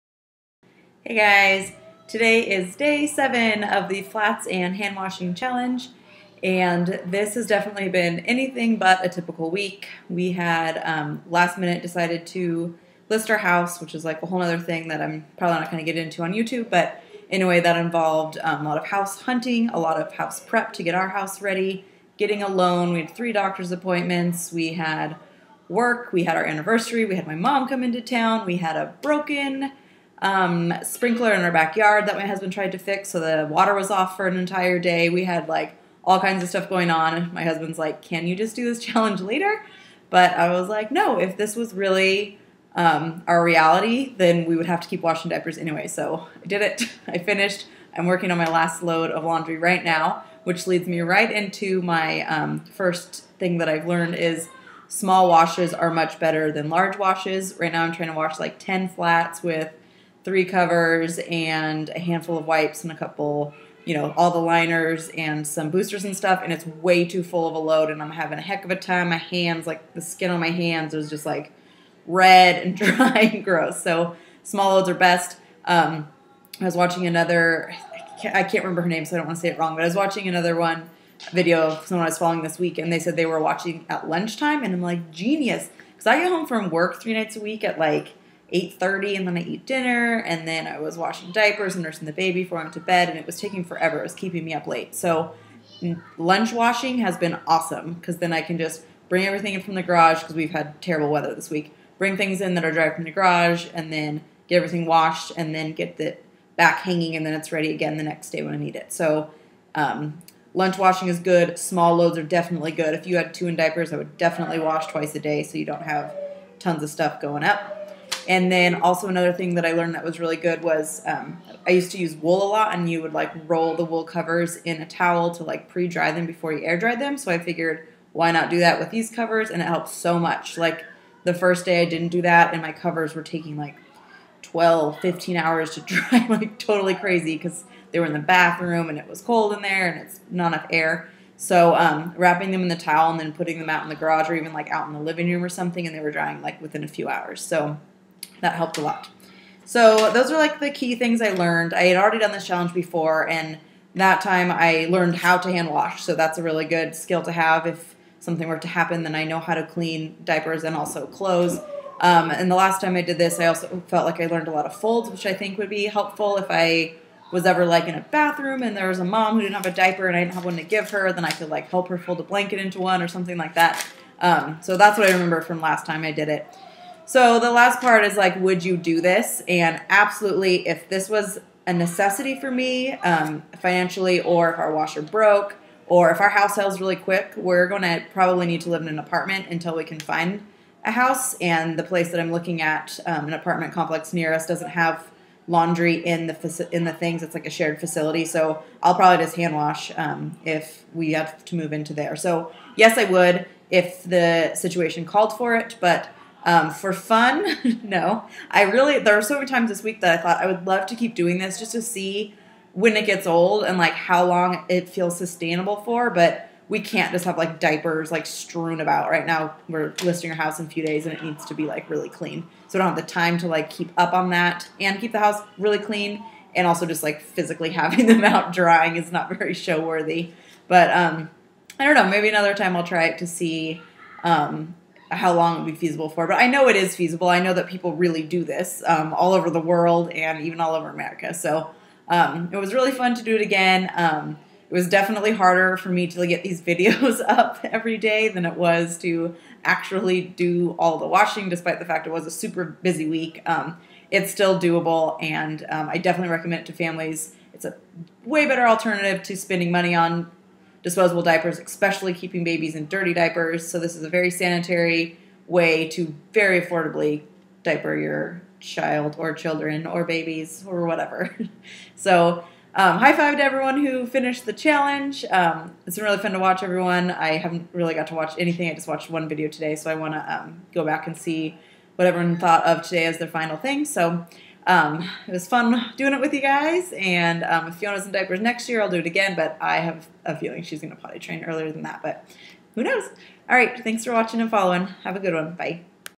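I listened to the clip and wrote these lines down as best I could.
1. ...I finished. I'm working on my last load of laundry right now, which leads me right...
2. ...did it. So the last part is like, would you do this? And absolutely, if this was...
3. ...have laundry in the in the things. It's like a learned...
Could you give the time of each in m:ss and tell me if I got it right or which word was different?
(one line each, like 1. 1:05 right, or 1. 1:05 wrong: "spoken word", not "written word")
1. 0:47 right
2. 2:56 right
3. 3:14 wrong: "shared", not "learned".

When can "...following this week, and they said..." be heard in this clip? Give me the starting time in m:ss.
1:22.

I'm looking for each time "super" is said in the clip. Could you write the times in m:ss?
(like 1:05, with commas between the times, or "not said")
4:12.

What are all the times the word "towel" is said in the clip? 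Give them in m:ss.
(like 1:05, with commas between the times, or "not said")
2:04, 2:22.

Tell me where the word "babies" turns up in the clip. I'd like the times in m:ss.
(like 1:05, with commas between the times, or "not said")
4:22, 4:30.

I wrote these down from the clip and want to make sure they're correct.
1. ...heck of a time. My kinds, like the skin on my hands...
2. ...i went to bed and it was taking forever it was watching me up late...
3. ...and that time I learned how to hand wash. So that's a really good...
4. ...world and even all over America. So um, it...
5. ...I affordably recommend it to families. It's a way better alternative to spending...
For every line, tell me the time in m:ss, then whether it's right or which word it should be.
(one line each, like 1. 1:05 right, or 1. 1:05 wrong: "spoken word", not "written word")
1. 1:08 wrong: "hands", not "kinds"
2. 1:32 wrong: "keeping", not "watching"
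3. 2:33 right
4. 3:59 right
5. 4:15 wrong: "definitely", not "affordably".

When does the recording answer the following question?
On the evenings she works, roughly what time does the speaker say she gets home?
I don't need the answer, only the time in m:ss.
1:28.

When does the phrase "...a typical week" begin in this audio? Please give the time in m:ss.
0:09.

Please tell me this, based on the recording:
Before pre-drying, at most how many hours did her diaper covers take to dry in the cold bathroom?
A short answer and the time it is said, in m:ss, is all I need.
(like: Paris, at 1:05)
15, at 2:14.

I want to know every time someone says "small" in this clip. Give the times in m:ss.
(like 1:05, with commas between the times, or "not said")
0:54, 1:14, 1:51.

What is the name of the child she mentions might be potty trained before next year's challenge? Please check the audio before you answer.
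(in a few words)
Fiona.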